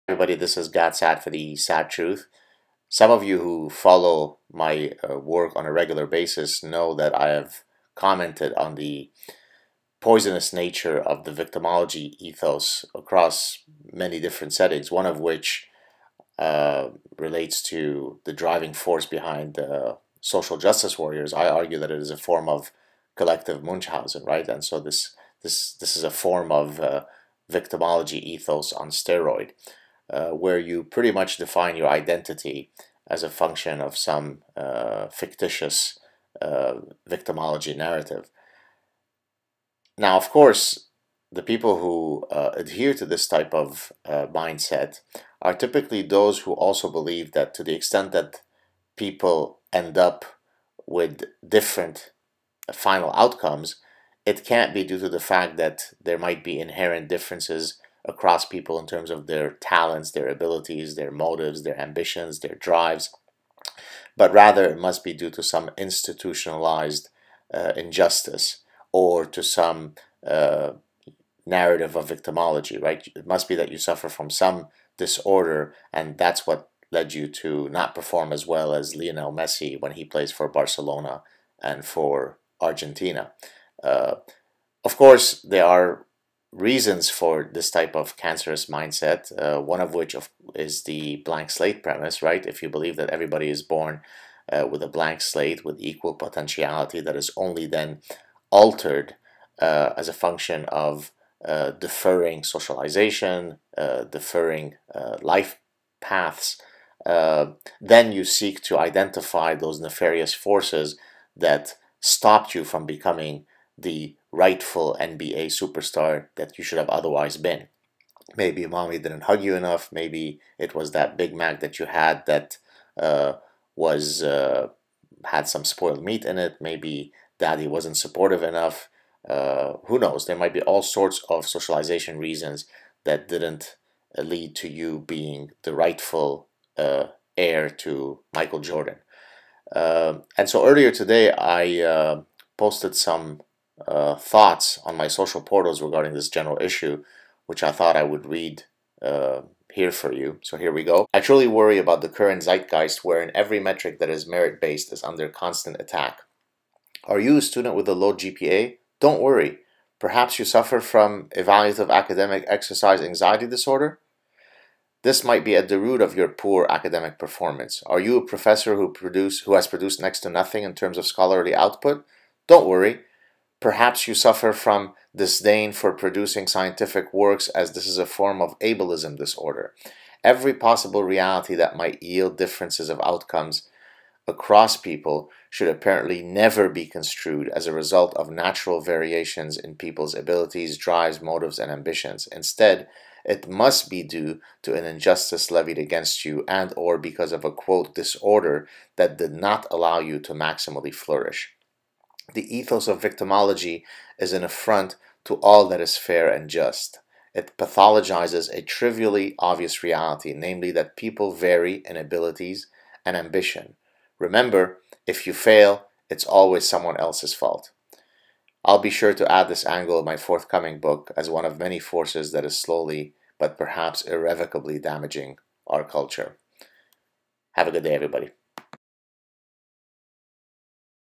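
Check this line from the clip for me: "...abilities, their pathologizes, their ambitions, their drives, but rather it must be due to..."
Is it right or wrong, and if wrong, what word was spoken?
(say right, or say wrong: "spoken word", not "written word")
wrong: "motives", not "pathologizes".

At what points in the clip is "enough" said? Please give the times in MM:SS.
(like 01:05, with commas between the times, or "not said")
01:59, 02:08.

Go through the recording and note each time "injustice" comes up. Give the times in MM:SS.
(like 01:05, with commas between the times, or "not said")
01:07, 03:14.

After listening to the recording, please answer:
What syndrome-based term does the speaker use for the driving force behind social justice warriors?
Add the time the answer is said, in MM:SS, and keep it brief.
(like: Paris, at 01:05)
Collective Munchausen, at 00:23.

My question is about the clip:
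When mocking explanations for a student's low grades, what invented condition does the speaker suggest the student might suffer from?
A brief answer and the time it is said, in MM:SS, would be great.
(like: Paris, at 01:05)
Evaluative academic exercise anxiety disorder, at 02:41.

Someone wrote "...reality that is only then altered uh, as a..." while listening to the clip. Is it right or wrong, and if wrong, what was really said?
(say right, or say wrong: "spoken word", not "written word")
wrong: "potentiality", not "reality".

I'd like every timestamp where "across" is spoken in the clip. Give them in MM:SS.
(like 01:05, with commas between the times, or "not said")
00:12, 00:58, 03:04.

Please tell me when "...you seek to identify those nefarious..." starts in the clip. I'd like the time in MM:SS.
01:48.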